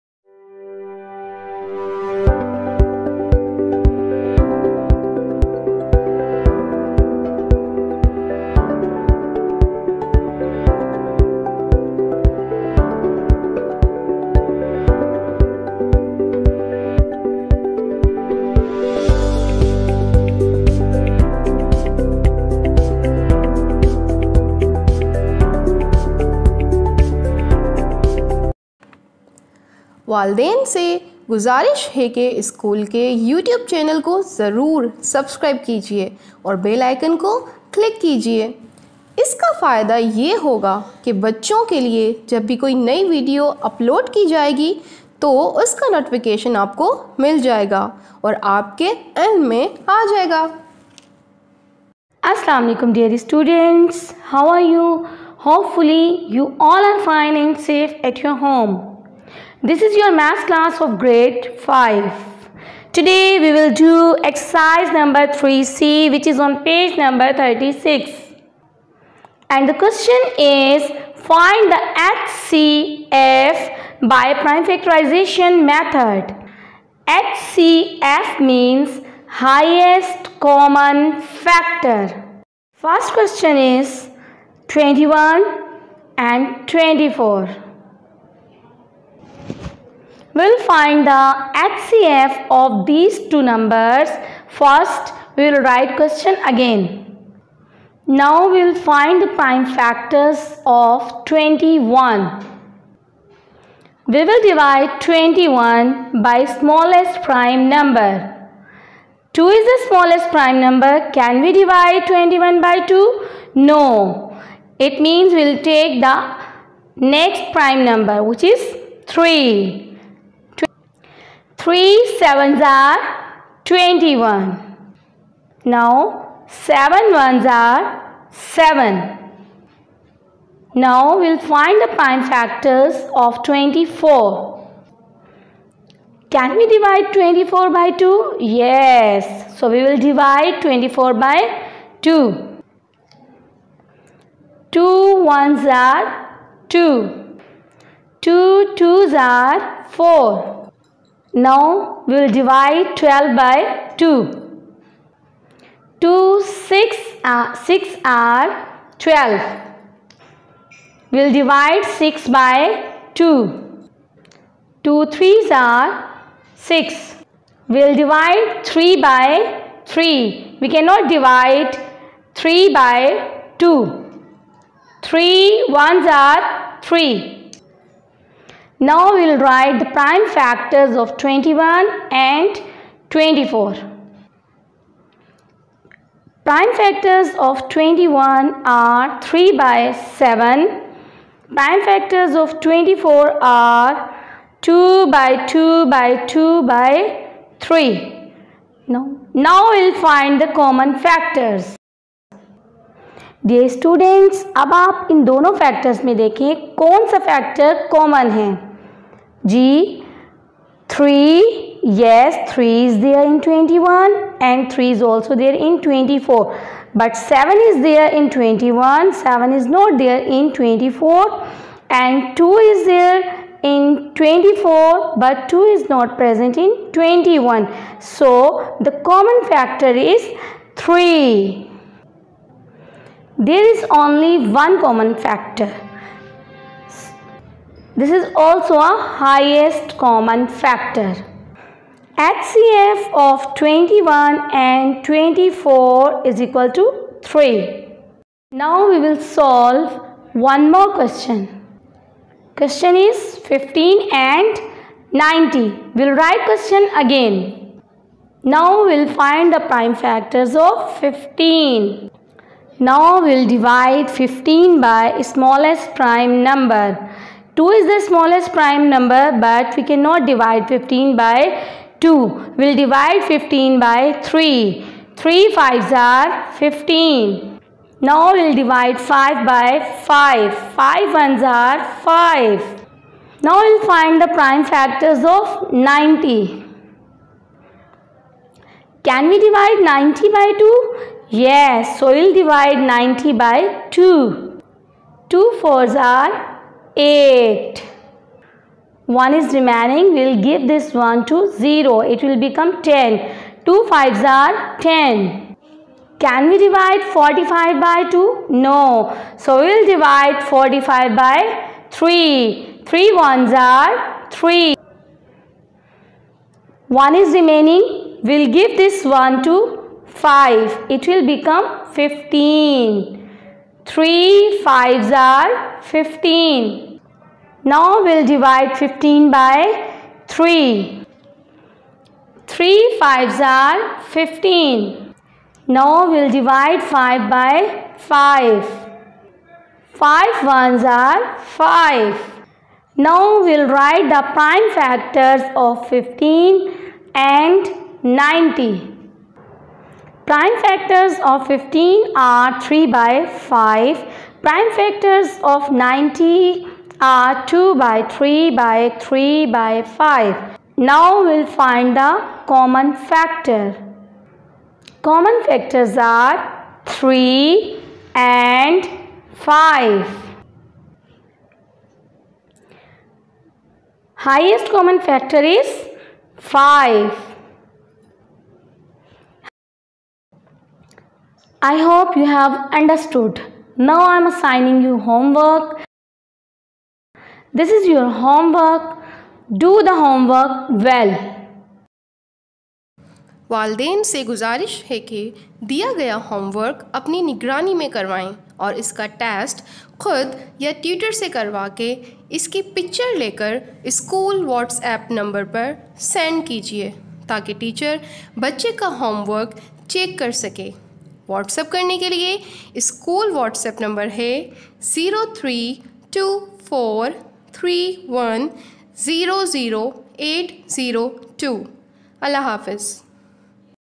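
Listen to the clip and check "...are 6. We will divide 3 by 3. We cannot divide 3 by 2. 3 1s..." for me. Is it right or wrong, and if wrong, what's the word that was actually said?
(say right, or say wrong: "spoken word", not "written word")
right.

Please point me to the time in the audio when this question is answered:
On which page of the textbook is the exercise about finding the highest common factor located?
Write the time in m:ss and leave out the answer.
1:07.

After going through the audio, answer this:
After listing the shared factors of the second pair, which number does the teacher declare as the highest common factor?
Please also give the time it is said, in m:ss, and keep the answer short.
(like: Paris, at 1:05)
5, at 6:14.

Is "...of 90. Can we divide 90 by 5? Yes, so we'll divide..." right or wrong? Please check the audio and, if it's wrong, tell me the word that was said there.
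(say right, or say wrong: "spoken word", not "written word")
wrong: "2", not "5".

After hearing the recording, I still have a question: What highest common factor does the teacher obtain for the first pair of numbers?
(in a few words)
3.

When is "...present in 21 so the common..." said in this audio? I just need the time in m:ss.
3:46.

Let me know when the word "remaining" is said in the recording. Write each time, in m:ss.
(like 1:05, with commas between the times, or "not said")
4:59, 5:17.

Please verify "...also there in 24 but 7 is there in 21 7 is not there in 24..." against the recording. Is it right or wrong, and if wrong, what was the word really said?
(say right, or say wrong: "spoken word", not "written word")
right.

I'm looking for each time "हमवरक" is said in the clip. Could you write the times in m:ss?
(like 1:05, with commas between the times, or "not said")
6:36, 6:49.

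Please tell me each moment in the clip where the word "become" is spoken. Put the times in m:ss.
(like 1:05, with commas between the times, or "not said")
5:02, 5:21.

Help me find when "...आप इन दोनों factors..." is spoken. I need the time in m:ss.
3:24.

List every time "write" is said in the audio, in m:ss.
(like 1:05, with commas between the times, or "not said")
1:35, 2:59, 4:16, 5:43.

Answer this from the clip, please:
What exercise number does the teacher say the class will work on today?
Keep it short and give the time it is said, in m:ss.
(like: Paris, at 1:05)
3C, at 1:05.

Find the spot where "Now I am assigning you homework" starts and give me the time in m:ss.
6:23.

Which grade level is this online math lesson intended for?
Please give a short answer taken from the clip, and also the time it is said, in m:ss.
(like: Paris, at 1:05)
5, at 1:00.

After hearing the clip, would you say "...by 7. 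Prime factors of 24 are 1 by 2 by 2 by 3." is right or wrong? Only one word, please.
wrong.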